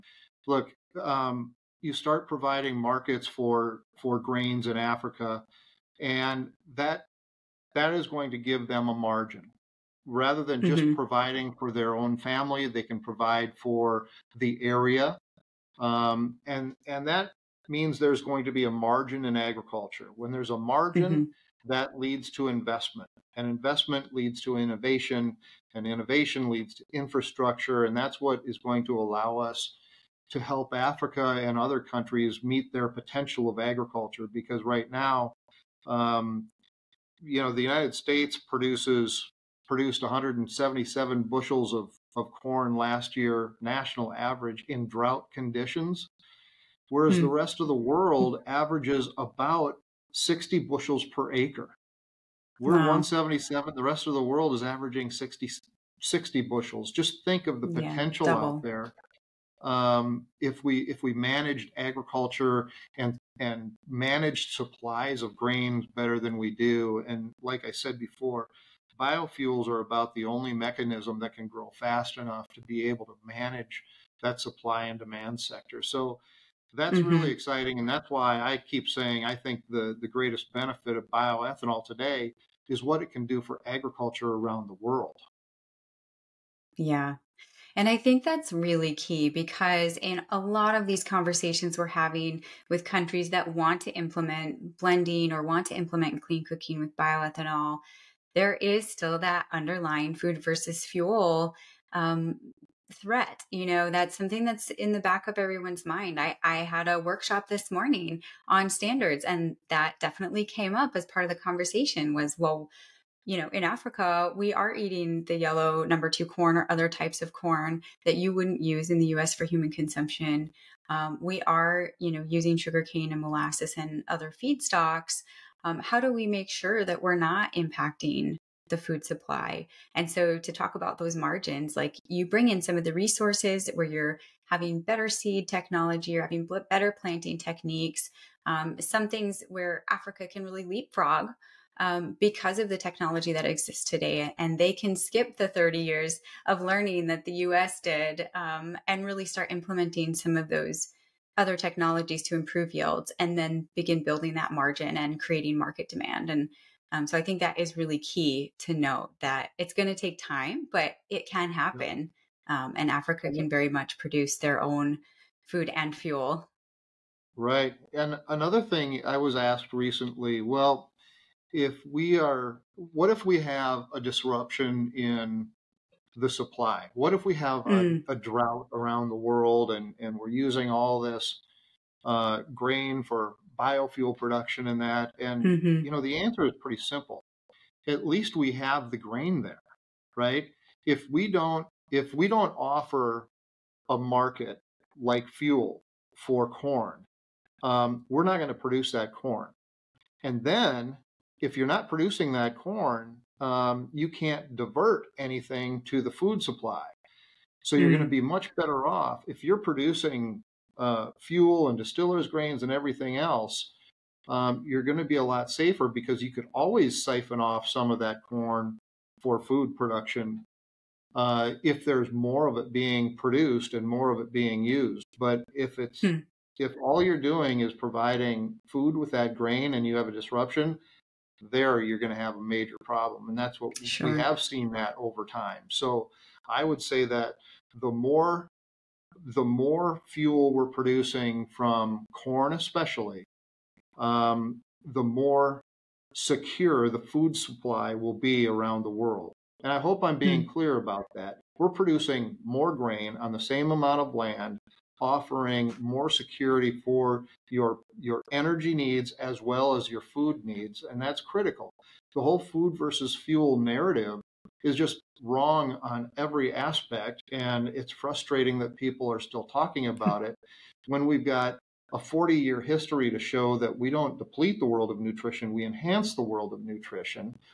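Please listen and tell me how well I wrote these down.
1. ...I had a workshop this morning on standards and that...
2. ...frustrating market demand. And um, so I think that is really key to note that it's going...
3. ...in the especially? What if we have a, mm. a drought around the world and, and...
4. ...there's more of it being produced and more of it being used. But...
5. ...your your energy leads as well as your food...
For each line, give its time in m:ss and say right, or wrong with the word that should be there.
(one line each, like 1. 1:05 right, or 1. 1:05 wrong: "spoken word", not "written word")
1. 1:46 right
2. 2:35 wrong: "creating", not "frustrating"
3. 2:54 wrong: "supply", not "especially"
4. 3:41 right
5. 4:17 wrong: "needs", not "leads".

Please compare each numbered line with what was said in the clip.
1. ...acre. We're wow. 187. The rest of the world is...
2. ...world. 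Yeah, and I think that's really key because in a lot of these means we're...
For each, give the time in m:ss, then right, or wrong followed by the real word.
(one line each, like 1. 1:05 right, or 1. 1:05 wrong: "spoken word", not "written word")
1. 0:51 wrong: "177", not "187"
2. 1:24 wrong: "conversations", not "means".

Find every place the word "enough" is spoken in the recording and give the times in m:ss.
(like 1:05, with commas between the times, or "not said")
1:12.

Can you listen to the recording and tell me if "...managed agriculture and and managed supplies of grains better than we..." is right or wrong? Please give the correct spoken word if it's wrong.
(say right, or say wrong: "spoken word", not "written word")
right.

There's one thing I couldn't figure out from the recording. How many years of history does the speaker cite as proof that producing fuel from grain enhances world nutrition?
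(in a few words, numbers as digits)
40.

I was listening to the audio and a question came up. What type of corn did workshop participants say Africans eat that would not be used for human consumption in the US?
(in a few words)
yellow number two corn.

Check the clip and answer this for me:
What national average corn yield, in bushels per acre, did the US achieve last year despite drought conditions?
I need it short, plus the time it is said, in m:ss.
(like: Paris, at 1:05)
177, at 0:40.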